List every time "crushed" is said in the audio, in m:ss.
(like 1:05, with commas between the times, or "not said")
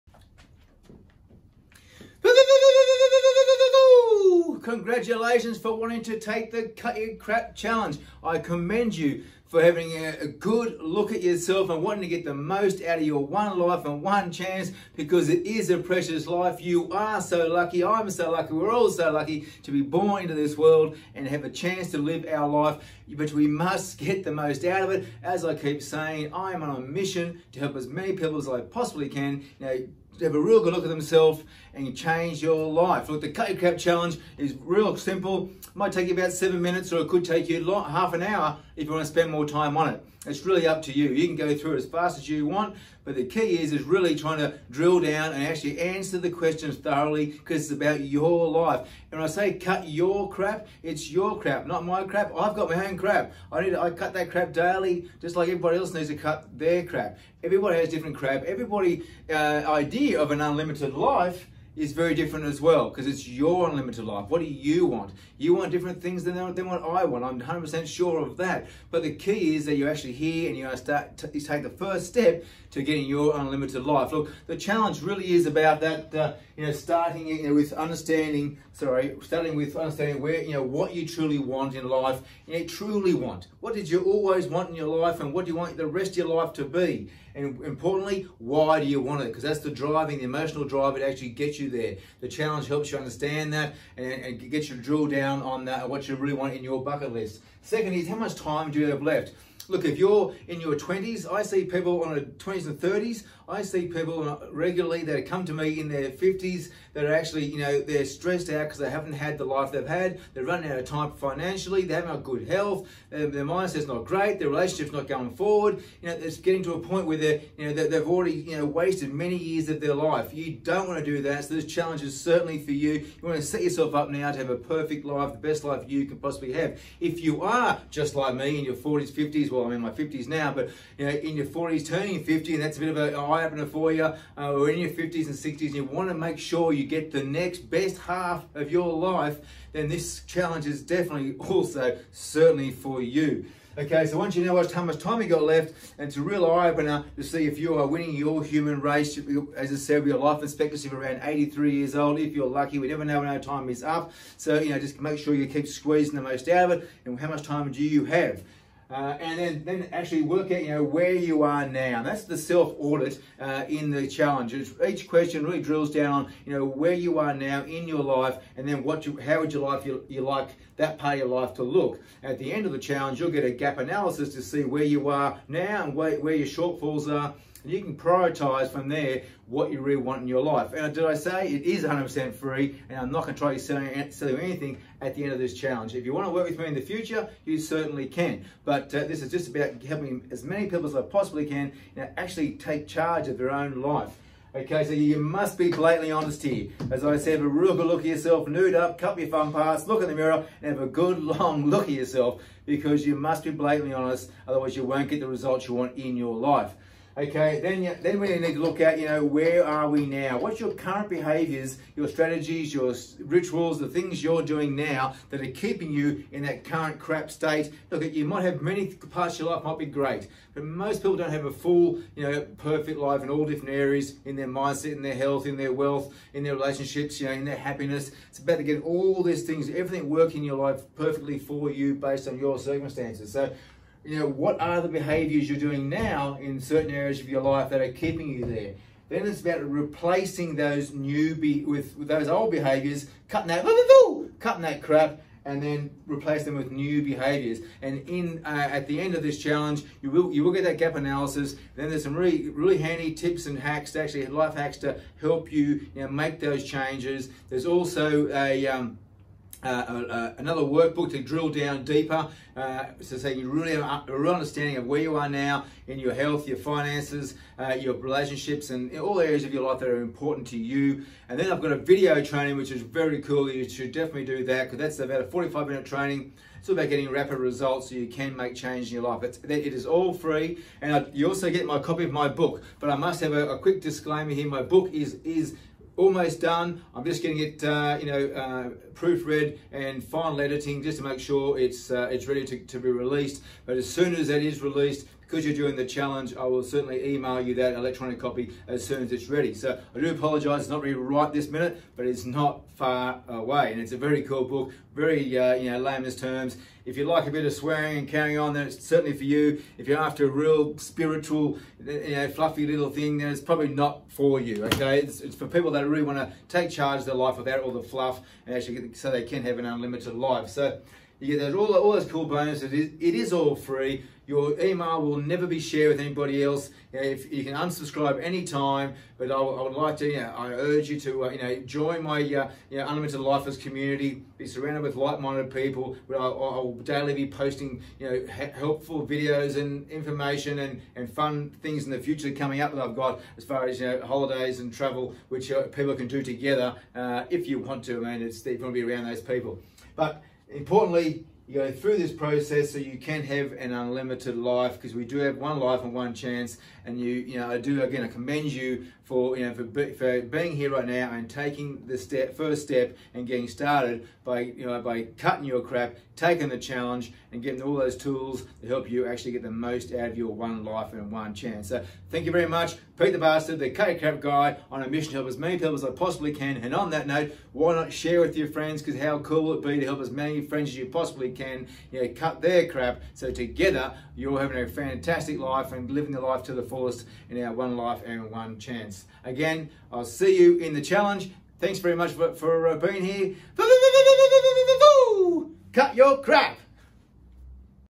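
not said.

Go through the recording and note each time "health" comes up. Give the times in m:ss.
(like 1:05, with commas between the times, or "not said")
1:52, 3:45, 4:26.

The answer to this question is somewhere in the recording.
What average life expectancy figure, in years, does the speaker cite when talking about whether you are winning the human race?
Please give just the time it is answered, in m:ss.
2:31.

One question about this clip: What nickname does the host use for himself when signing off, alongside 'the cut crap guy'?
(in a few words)
Peter the Bastard.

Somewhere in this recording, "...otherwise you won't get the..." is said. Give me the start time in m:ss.
3:24.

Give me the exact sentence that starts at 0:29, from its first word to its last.
Now have a real good look at themselves and change your life.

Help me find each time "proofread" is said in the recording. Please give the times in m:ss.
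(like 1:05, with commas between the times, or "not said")
4:48.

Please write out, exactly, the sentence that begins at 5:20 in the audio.
So you get those, all, all those cool bonuses.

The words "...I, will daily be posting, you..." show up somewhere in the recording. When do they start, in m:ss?
5:36.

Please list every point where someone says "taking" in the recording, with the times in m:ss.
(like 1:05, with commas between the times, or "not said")
6:01, 6:06.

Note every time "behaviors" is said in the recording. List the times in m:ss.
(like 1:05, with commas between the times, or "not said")
3:31, 3:54, 4:02, 4:07.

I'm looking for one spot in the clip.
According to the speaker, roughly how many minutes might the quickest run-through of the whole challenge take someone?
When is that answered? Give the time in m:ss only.
0:36.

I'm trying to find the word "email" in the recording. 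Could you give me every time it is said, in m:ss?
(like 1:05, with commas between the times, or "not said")
4:57, 5:24.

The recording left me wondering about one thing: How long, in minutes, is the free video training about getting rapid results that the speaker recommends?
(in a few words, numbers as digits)
45 minutes.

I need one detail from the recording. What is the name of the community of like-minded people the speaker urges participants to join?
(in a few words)
Unlimited Lifers.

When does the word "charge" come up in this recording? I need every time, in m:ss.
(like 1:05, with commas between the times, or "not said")
3:12, 5:16.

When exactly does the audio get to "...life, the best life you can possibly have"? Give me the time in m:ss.
2:05.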